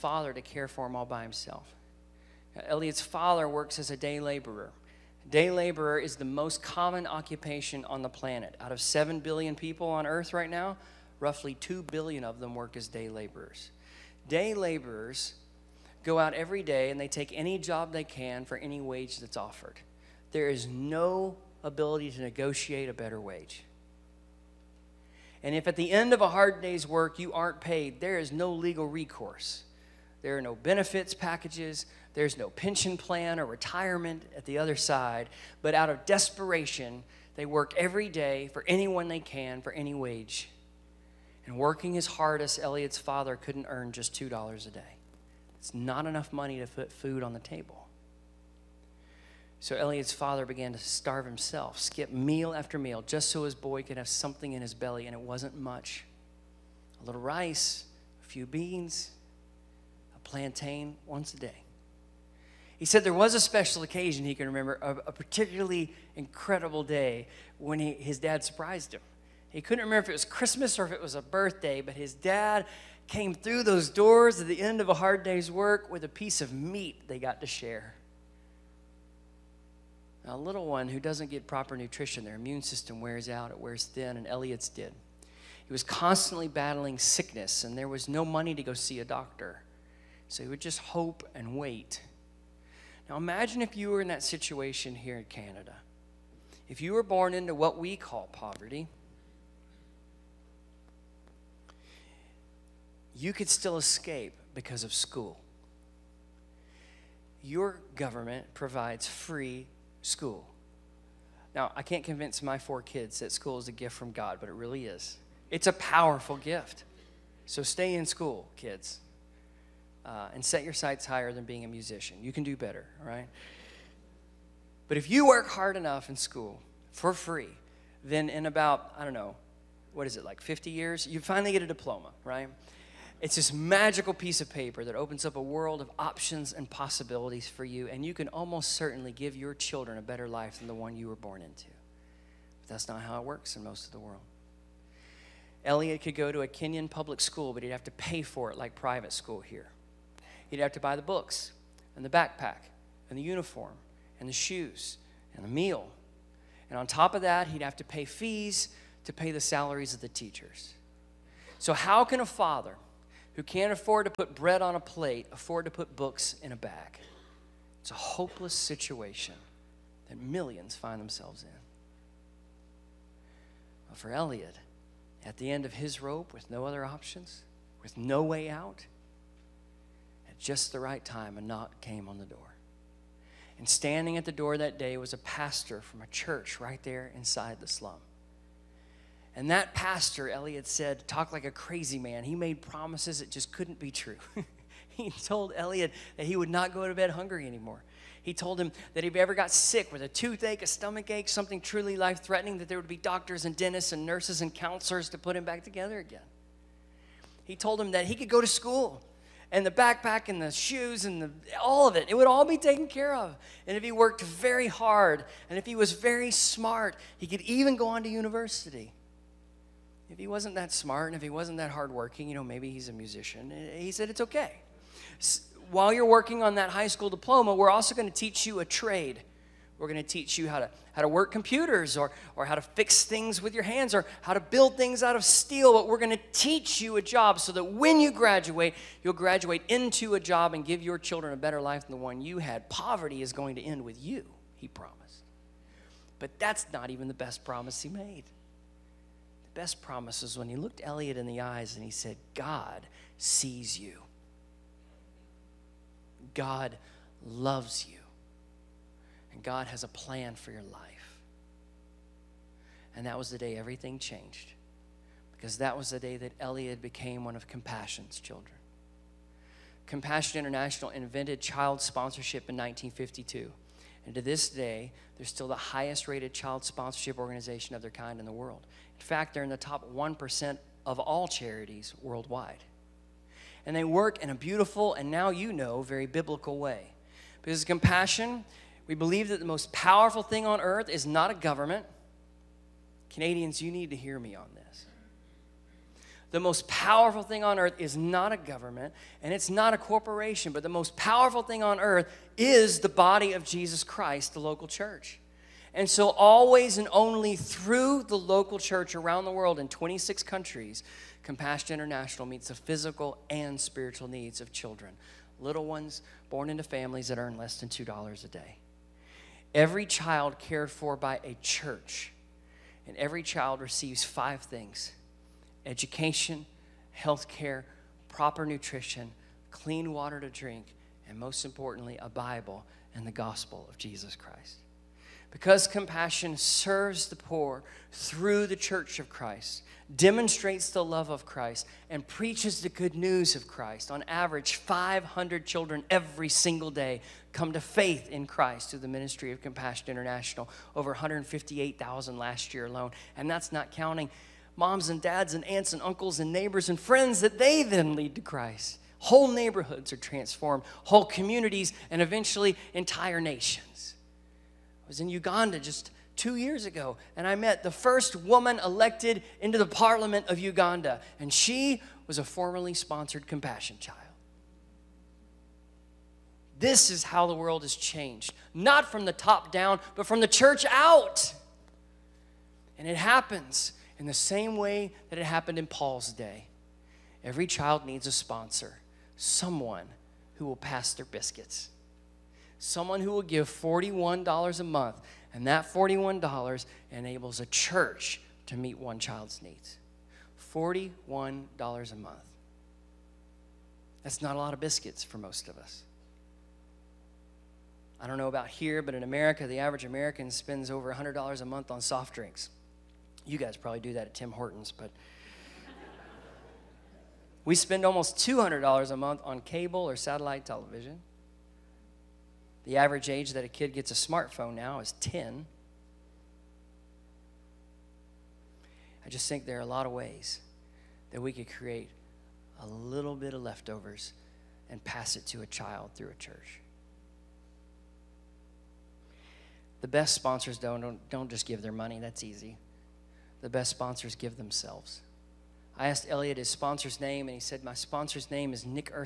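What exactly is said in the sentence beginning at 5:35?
Because compassion serves the poor through the church of Christ, demonstrates the love of Christ, and preaches the good news of Christ.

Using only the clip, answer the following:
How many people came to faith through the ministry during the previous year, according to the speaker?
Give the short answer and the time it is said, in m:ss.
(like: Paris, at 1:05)
over 158,000, at 5:50.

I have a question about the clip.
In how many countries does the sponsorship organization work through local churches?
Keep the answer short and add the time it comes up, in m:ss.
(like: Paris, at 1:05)
26, at 5:09.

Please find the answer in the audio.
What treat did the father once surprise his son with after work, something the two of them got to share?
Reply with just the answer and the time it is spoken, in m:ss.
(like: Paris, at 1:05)
a piece of meat, at 1:16.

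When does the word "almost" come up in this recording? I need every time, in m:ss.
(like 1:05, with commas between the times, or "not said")
2:18, 6:57.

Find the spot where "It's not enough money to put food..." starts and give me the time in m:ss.
0:45.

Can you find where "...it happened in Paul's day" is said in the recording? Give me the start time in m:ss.
6:25.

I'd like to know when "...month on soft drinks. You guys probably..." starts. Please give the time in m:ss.
6:51.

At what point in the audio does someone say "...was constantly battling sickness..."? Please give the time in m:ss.
1:25.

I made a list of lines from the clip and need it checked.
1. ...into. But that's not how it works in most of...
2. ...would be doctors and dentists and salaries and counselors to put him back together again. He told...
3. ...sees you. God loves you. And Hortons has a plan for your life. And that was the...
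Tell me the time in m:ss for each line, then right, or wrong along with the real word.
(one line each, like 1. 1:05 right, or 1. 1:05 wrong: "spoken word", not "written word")
1. 2:21 right
2. 3:22 wrong: "nurses", not "salaries"
3. 4:13 wrong: "God", not "Hortons".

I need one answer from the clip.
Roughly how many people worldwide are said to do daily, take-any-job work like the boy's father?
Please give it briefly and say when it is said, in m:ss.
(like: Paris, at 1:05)
2 billion, at 0:11.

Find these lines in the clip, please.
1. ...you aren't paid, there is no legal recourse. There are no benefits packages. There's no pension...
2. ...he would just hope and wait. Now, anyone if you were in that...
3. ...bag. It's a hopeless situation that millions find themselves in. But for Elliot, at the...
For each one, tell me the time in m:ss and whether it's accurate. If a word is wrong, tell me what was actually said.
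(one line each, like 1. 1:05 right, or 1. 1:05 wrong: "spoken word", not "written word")
1. 0:27 right
2. 1:30 wrong: "imagine", not "anyone"
3. 2:46 right.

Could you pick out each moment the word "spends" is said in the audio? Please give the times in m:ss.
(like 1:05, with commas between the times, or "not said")
6:50, 6:57.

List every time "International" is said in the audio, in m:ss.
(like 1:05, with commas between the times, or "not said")
4:30, 5:11, 5:49.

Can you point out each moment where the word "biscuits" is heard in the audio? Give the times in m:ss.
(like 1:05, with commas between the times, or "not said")
6:31, 6:44.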